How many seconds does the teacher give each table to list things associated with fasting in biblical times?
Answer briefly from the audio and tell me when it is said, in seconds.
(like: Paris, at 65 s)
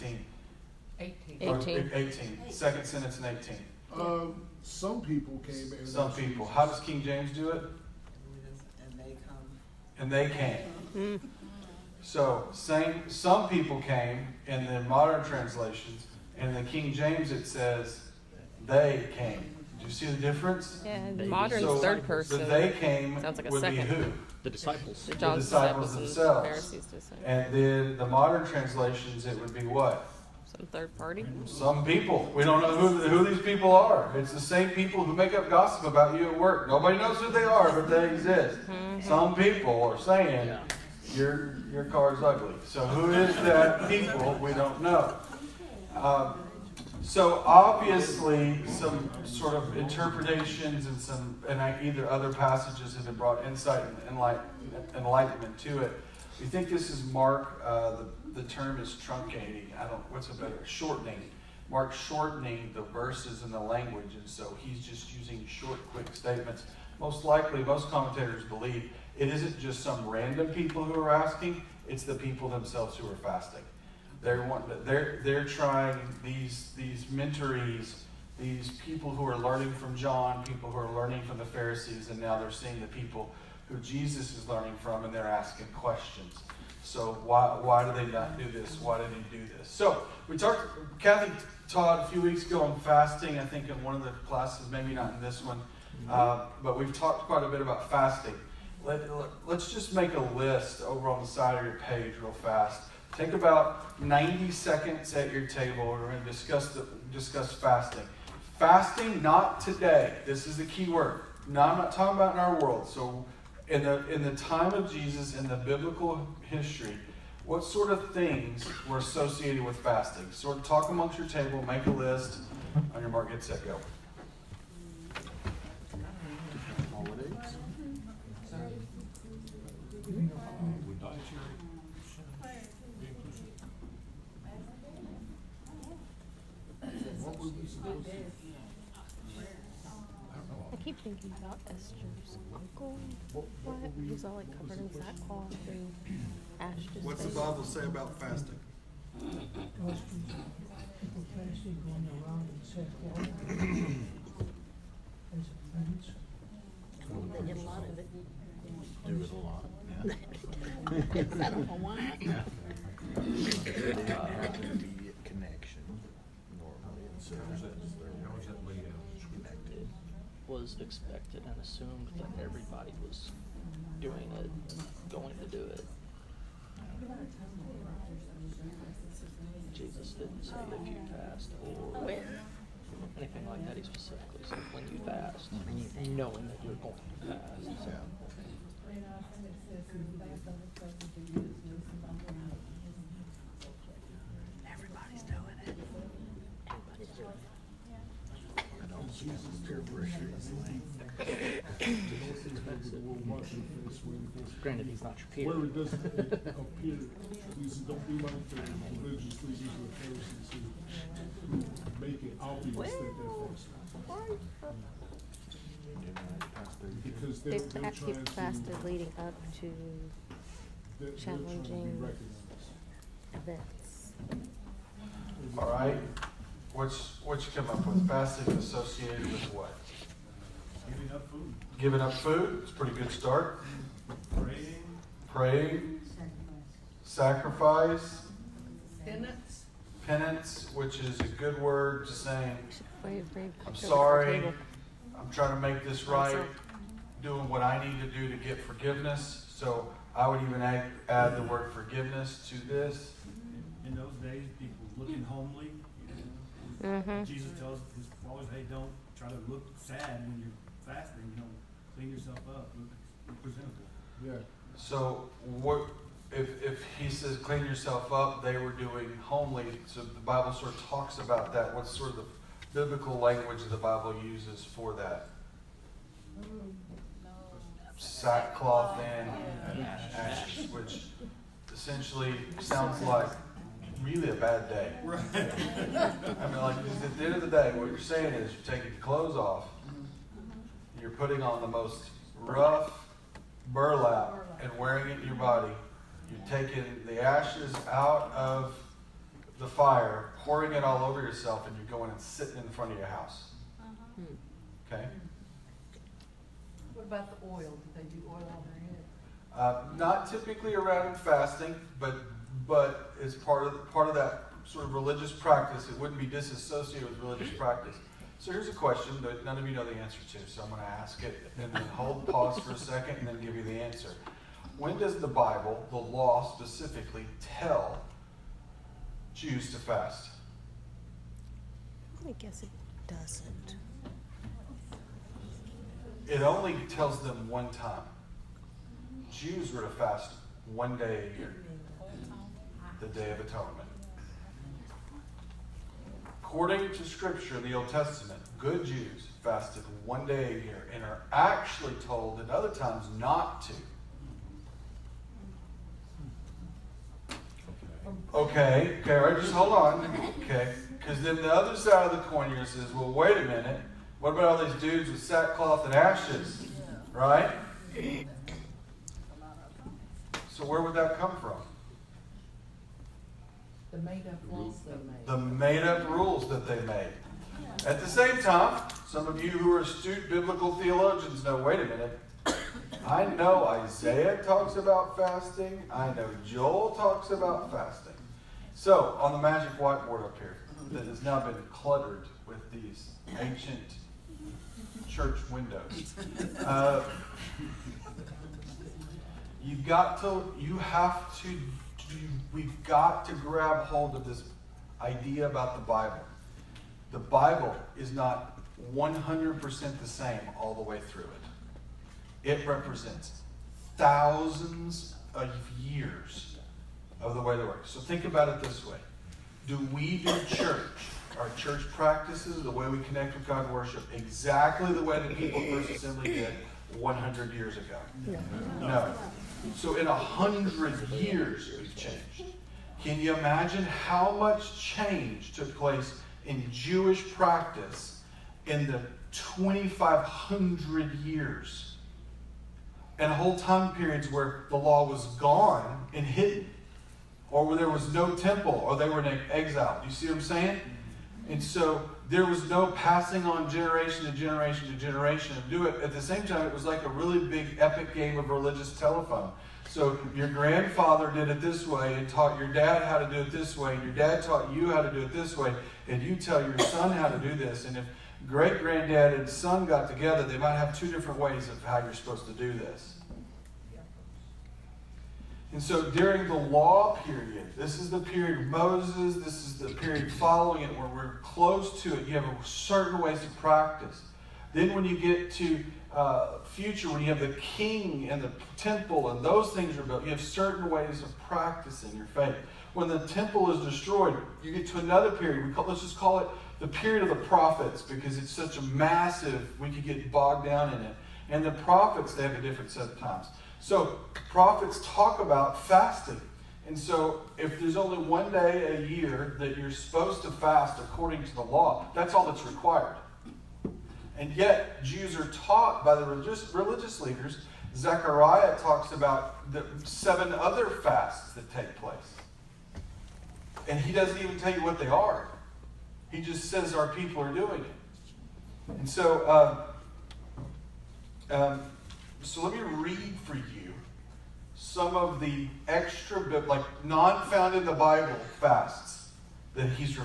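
90, at 104 s.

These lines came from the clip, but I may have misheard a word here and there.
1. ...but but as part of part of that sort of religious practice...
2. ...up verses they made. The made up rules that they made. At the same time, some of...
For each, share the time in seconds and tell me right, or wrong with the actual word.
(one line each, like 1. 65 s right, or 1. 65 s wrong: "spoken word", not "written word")
1. 311 s right
2. 374 s wrong: "rules", not "verses".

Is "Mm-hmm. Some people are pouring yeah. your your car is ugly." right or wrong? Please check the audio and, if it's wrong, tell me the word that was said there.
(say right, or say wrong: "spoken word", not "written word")
wrong: "saying", not "pouring".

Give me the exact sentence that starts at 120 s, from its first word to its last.
Sort of talk amongst your table, make a list.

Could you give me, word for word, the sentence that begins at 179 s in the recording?
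Jesus didn't say if you fast or Where?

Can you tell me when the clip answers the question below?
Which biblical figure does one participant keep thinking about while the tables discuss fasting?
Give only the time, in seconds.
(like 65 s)
141 s.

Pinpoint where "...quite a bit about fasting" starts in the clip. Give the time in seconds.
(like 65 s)
97 s.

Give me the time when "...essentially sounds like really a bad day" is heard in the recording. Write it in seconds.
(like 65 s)
281 s.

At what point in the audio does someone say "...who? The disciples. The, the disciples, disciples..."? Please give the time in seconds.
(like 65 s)
23 s.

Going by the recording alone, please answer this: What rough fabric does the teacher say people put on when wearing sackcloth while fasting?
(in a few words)
burlap.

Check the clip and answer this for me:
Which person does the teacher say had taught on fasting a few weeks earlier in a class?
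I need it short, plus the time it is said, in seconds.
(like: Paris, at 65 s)
Kathy, at 90 s.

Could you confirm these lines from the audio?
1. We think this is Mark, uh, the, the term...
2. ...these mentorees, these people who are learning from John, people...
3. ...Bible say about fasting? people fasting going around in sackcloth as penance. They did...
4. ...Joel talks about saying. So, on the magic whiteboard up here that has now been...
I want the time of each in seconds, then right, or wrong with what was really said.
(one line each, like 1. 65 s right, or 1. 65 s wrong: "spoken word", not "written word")
1. 56 s right
2. 76 s right
3. 147 s right
4. 386 s wrong: "fasting", not "saying".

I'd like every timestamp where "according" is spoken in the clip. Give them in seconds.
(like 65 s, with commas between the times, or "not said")
346 s, 510 s.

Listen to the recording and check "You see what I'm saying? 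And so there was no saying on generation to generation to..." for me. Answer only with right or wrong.
wrong.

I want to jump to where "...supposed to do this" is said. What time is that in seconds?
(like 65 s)
472 s.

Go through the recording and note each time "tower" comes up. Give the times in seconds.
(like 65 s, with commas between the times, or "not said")
not said.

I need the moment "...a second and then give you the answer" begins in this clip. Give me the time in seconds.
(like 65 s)
322 s.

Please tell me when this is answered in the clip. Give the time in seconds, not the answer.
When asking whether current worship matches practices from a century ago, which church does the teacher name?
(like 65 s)
425 s.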